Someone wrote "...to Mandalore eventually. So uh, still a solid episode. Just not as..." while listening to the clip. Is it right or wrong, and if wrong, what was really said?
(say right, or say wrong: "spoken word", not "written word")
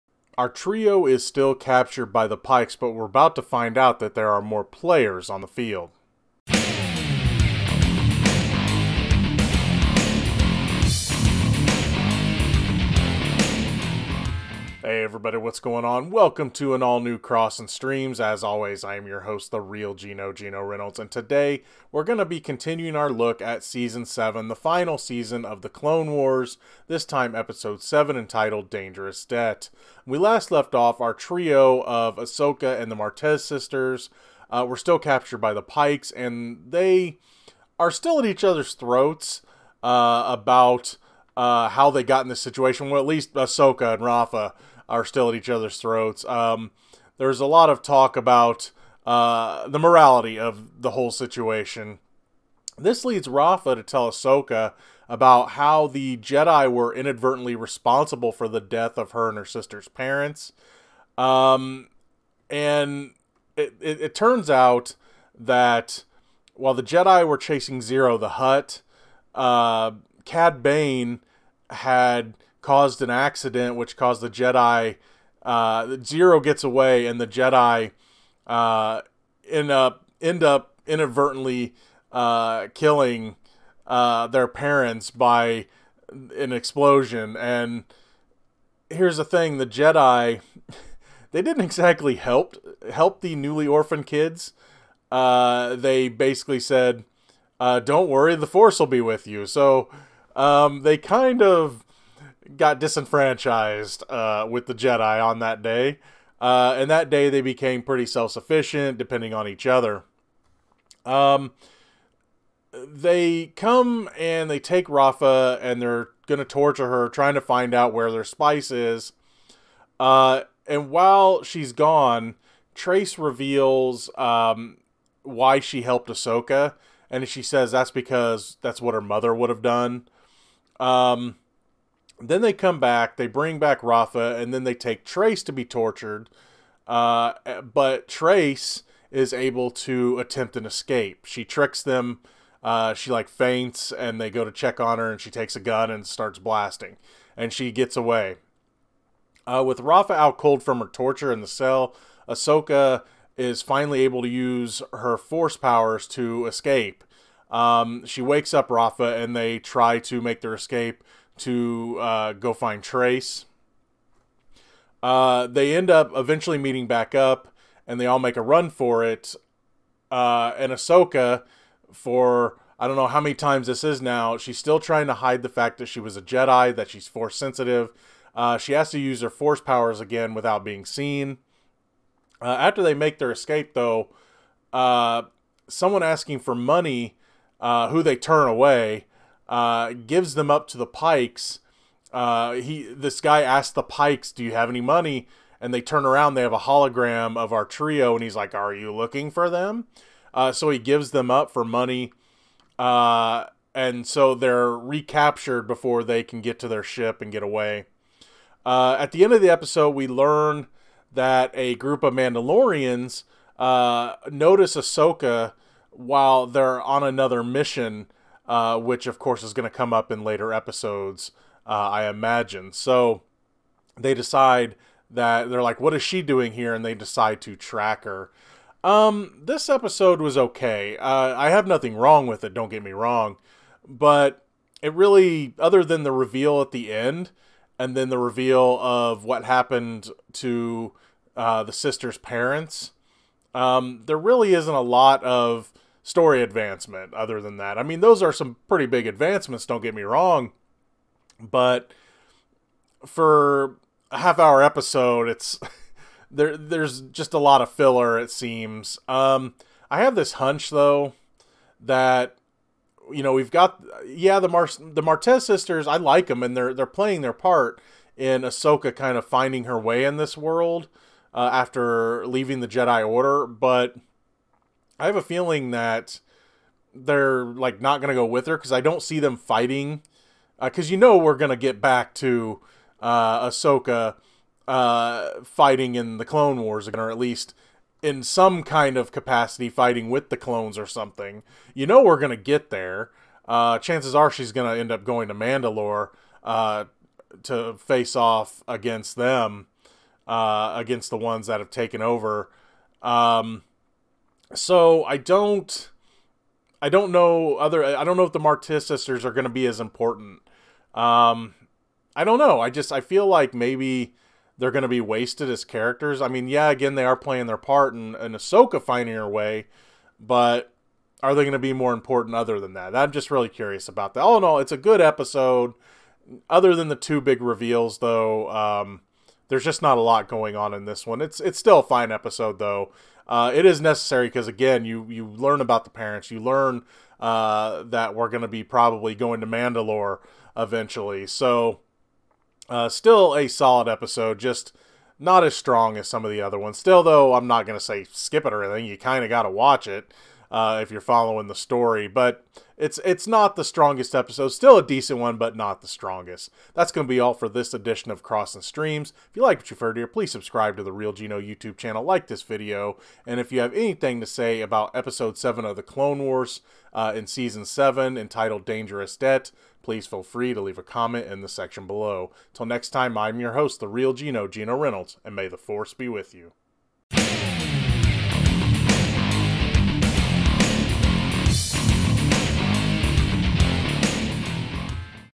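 right.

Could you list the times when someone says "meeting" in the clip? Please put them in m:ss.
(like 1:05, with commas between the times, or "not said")
2:46.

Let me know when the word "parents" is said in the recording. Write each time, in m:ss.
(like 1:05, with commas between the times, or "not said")
0:59, 1:24, 4:02, 5:35.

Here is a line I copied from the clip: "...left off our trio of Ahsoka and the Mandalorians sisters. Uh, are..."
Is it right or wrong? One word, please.
wrong.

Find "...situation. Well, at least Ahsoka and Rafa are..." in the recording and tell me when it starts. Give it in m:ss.
0:42.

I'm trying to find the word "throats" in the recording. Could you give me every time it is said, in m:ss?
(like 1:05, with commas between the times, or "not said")
0:38, 0:45.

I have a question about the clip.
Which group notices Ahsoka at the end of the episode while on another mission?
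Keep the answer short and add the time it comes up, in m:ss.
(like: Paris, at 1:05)
Mandalorians, at 3:32.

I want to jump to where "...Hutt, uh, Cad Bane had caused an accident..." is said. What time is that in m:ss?
1:08.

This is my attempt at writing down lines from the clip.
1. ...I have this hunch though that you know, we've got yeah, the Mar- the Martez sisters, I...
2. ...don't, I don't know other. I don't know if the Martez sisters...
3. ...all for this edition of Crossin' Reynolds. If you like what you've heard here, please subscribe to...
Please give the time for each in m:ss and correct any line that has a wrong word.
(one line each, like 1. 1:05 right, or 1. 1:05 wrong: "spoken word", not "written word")
1. 4:19 right
2. 5:05 right
3. 5:57 wrong: "Streams", not "Reynolds".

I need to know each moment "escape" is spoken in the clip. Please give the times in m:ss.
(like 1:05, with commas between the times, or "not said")
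2:20, 2:36, 2:40, 3:03.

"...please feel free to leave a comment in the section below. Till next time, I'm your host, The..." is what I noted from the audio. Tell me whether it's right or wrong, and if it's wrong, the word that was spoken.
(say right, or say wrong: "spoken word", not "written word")
right.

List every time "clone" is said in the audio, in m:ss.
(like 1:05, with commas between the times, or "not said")
0:25, 4:46, 4:50, 6:05.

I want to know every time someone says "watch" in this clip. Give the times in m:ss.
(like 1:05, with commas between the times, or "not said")
5:49.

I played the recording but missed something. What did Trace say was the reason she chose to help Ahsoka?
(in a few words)
What her mother would have done.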